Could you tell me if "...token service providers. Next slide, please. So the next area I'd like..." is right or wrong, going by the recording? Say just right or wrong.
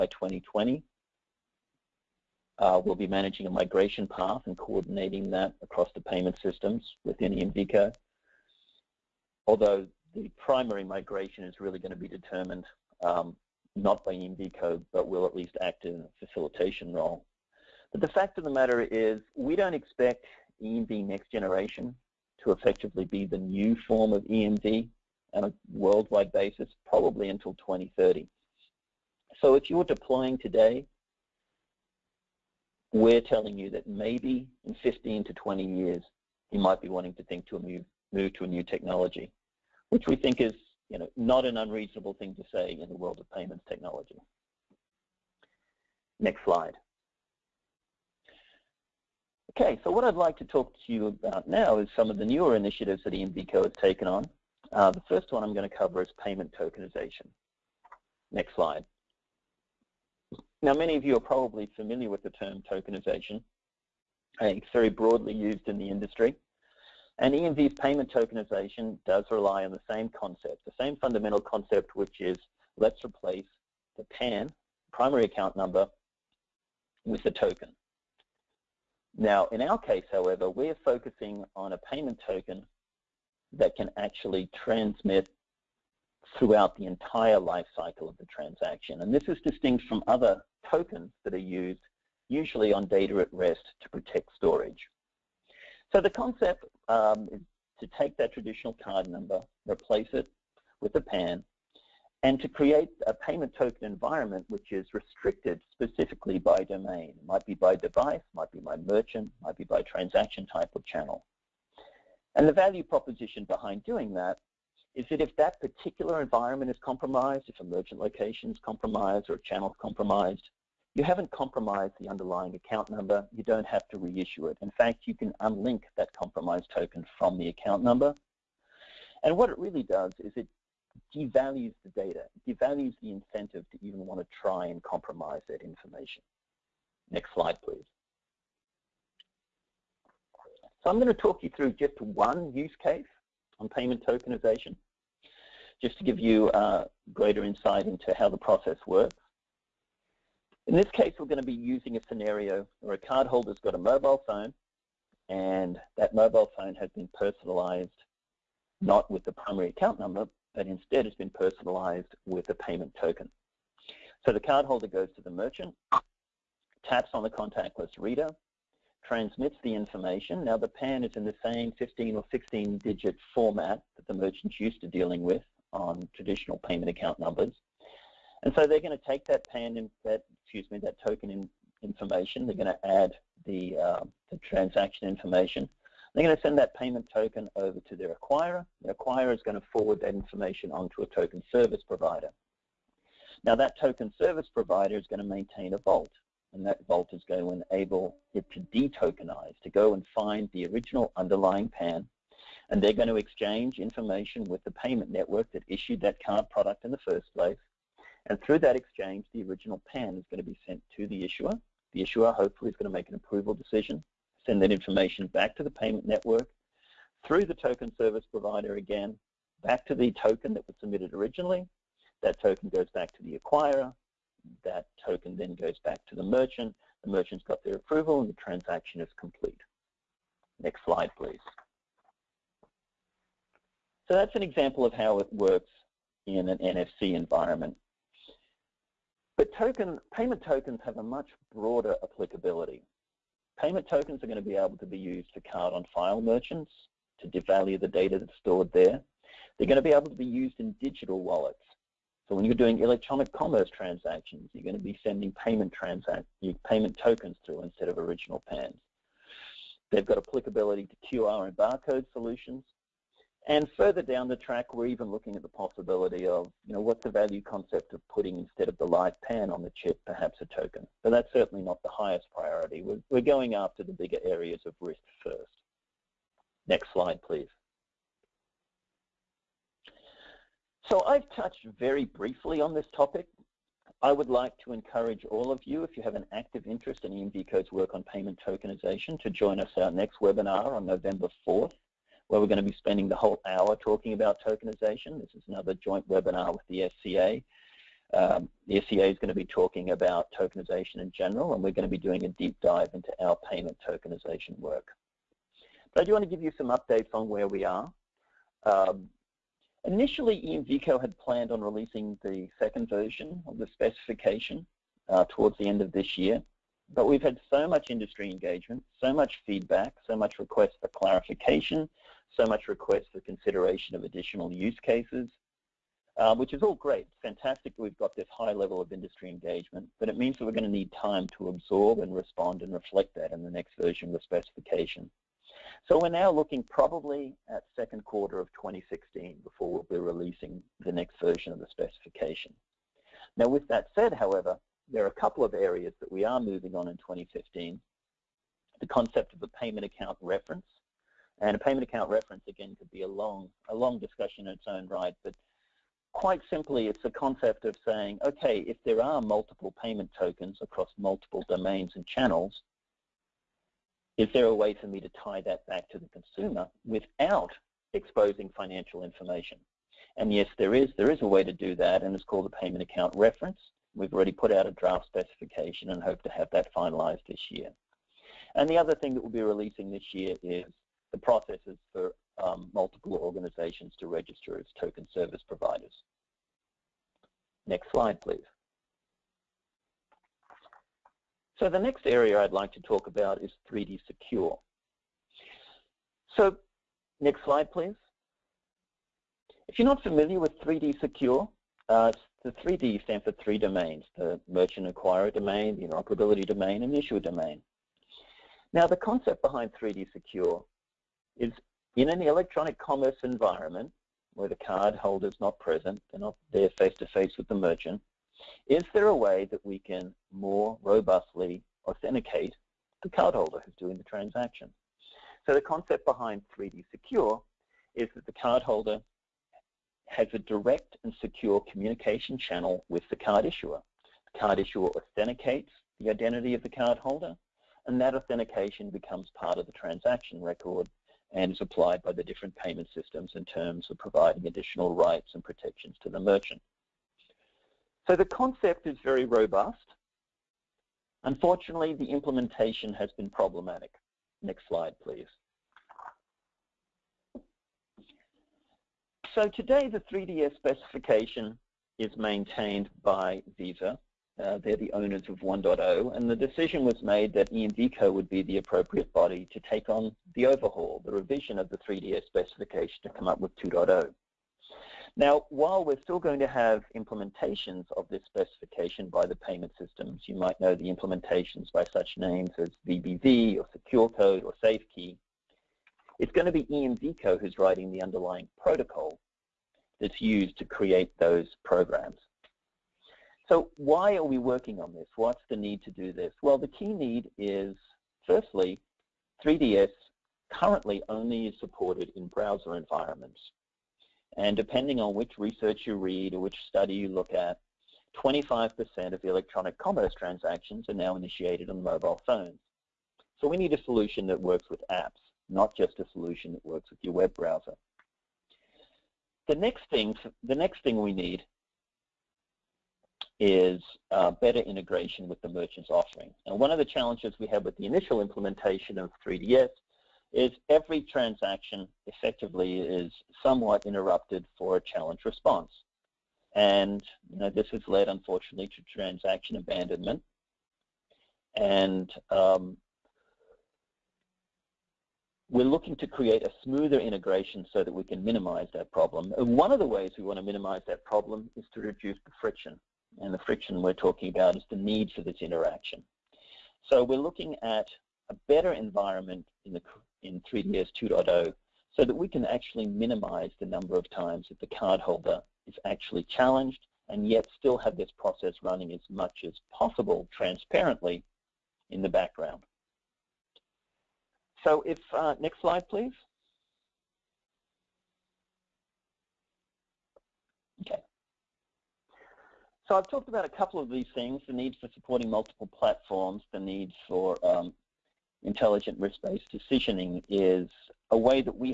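right.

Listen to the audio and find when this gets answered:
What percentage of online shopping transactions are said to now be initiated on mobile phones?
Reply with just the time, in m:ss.
8:28.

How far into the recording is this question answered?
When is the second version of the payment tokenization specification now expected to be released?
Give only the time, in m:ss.
5:37.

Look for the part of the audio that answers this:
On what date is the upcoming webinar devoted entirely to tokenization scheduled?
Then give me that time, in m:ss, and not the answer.
4:50.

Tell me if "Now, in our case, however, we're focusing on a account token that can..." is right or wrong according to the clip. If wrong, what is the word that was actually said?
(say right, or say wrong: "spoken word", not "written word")
wrong: "payment", not "account".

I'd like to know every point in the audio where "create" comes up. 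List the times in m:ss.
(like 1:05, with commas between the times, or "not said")
1:42, 8:10, 9:06.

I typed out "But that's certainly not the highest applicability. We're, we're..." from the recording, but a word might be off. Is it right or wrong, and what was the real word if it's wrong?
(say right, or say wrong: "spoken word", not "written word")
wrong: "priority", not "applicability".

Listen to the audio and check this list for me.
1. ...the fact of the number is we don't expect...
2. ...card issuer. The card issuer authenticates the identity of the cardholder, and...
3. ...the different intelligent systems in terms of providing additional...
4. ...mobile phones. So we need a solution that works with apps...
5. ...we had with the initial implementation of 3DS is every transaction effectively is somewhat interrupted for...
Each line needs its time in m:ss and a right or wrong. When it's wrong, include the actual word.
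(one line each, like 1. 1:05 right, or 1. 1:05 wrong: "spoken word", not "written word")
1. 0:18 wrong: "matter", not "number"
2. 7:13 right
3. 7:22 wrong: "payment", not "intelligent"
4. 8:31 right
5. 8:47 right.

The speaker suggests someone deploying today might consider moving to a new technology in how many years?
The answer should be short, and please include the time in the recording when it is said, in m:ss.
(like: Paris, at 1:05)
15 to 20, at 0:34.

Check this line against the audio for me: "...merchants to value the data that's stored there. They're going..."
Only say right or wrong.
wrong.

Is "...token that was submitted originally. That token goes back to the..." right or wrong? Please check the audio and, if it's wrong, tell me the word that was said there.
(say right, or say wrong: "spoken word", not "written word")
right.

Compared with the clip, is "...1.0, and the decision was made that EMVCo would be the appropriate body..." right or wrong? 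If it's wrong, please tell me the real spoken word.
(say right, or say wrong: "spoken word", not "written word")
right.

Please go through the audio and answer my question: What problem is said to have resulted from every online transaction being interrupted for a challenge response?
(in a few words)
Transaction abandonment.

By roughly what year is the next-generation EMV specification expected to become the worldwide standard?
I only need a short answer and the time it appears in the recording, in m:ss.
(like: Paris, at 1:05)
2030, at 0:27.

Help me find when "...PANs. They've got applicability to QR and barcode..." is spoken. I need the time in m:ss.
4:18.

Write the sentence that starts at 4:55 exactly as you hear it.
This is another joint webinar with the SCA.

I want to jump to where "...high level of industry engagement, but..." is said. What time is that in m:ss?
5:28.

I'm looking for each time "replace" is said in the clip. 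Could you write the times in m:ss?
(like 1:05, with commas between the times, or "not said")
1:13, 1:39.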